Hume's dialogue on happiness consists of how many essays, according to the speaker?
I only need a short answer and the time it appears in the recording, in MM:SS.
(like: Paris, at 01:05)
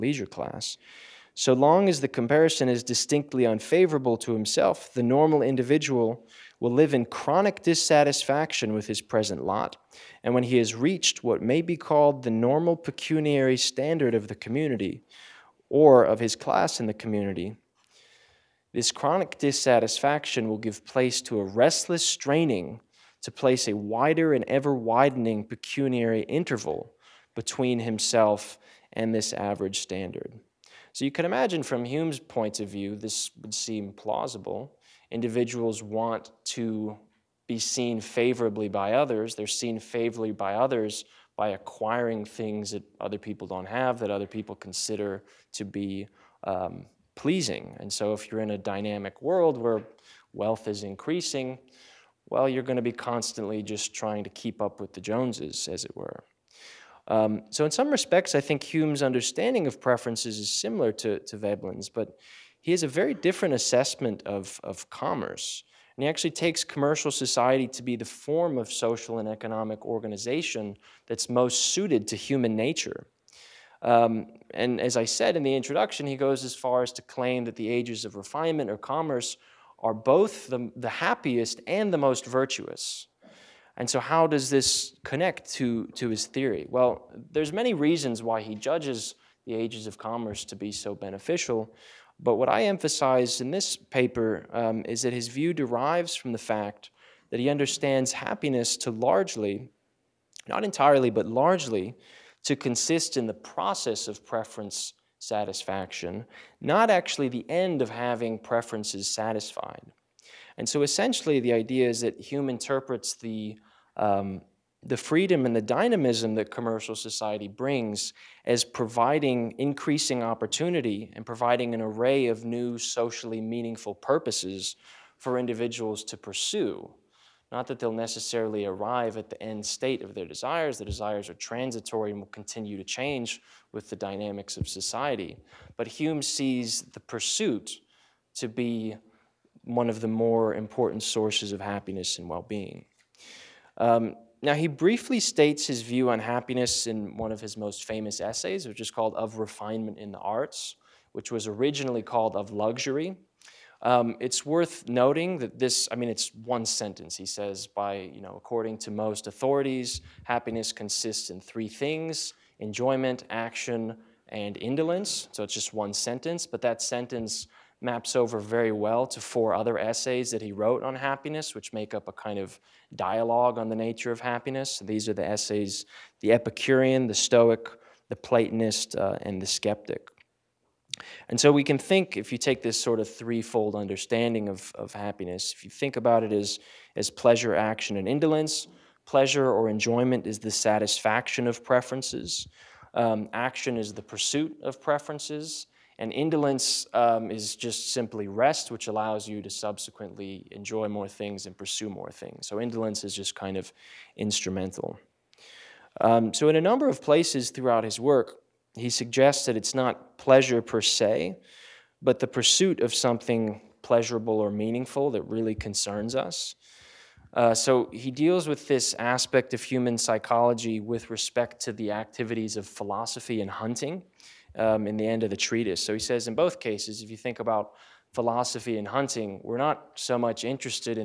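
4, at 02:49.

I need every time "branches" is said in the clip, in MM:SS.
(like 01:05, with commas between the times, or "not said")
not said.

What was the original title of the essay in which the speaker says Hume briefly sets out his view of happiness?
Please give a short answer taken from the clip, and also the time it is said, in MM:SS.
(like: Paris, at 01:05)
Of Luxury, at 02:32.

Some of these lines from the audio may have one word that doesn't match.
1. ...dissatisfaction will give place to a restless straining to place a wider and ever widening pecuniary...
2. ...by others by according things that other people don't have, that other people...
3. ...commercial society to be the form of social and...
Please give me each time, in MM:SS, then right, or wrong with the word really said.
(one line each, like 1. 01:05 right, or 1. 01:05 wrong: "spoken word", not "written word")
1. 00:19 right
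2. 00:40 wrong: "acquiring", not "according"
3. 01:06 right.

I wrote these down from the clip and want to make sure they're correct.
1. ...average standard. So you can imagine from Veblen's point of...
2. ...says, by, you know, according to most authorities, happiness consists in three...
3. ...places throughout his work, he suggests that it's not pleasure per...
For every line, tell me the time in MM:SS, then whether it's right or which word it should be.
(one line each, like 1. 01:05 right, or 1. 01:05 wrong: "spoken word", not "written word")
1. 00:29 wrong: "Hume", not "Veblen"
2. 02:37 right
3. 03:27 right.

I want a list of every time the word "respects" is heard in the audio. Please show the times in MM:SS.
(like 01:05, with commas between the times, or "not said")
00:57, 03:41.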